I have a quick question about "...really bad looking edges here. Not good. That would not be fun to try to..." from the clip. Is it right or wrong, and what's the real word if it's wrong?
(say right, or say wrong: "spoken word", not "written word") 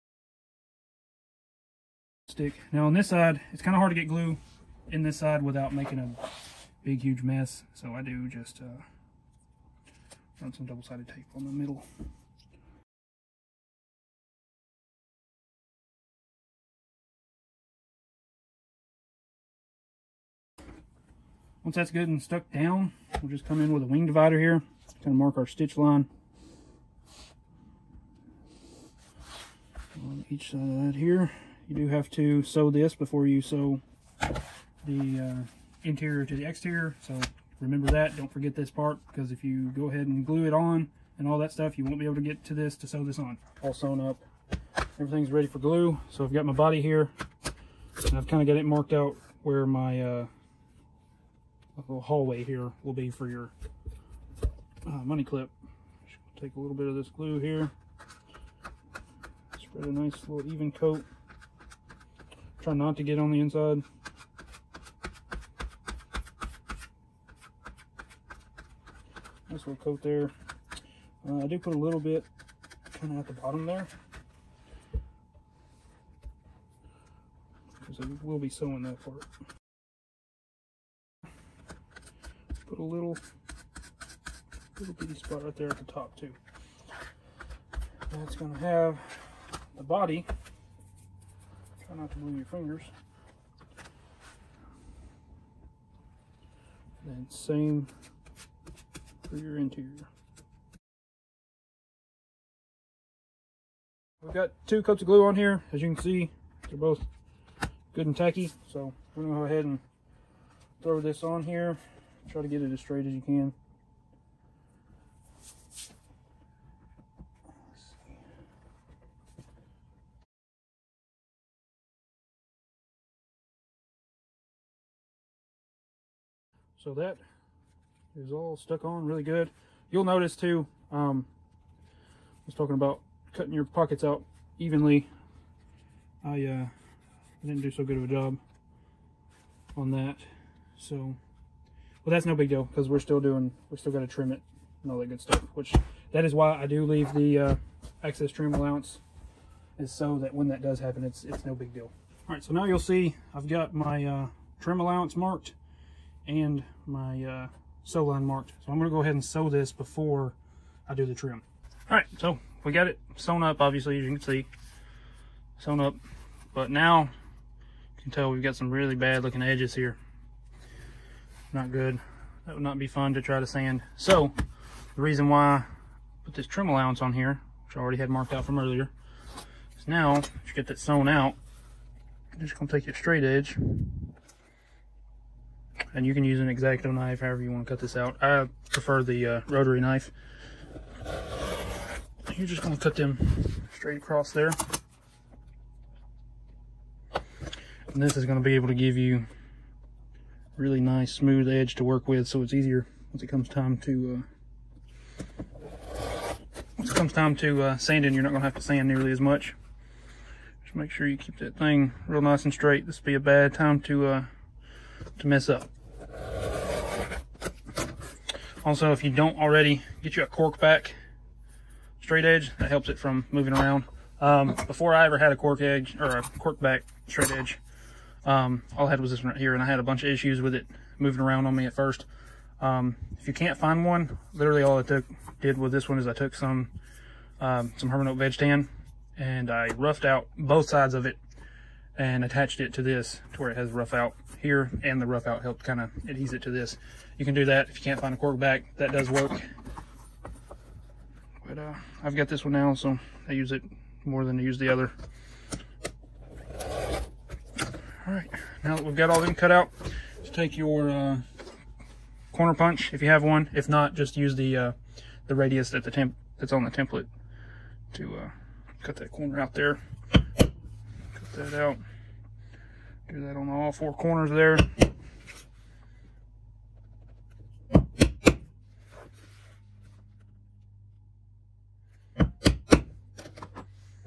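right.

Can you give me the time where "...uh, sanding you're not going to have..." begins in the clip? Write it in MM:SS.
03:27.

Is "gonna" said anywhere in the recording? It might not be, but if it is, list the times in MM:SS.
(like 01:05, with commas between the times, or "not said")
01:49, 02:38, 03:02.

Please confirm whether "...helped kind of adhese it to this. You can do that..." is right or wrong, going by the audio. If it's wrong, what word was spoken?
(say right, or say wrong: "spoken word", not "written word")
right.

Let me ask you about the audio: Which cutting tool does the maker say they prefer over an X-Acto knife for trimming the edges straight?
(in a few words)
Rotary knife.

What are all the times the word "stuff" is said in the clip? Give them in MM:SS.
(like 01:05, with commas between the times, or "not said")
00:41, 02:25.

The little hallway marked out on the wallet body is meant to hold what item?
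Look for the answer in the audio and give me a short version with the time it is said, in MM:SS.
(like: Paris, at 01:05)
Money clip, at 00:55.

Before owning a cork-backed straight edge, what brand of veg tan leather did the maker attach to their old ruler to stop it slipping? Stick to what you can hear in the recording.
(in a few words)
Hermann Oak.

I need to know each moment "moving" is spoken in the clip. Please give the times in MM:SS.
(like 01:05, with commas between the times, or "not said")
03:43, 03:50.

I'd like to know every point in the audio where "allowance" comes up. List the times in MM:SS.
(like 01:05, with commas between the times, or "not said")
02:28, 02:34, 02:56.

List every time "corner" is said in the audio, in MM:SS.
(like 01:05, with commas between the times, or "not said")
04:22, 04:29, 04:33.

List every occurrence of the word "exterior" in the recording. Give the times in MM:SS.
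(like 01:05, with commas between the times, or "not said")
00:36.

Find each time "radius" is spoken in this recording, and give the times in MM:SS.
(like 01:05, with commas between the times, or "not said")
04:25.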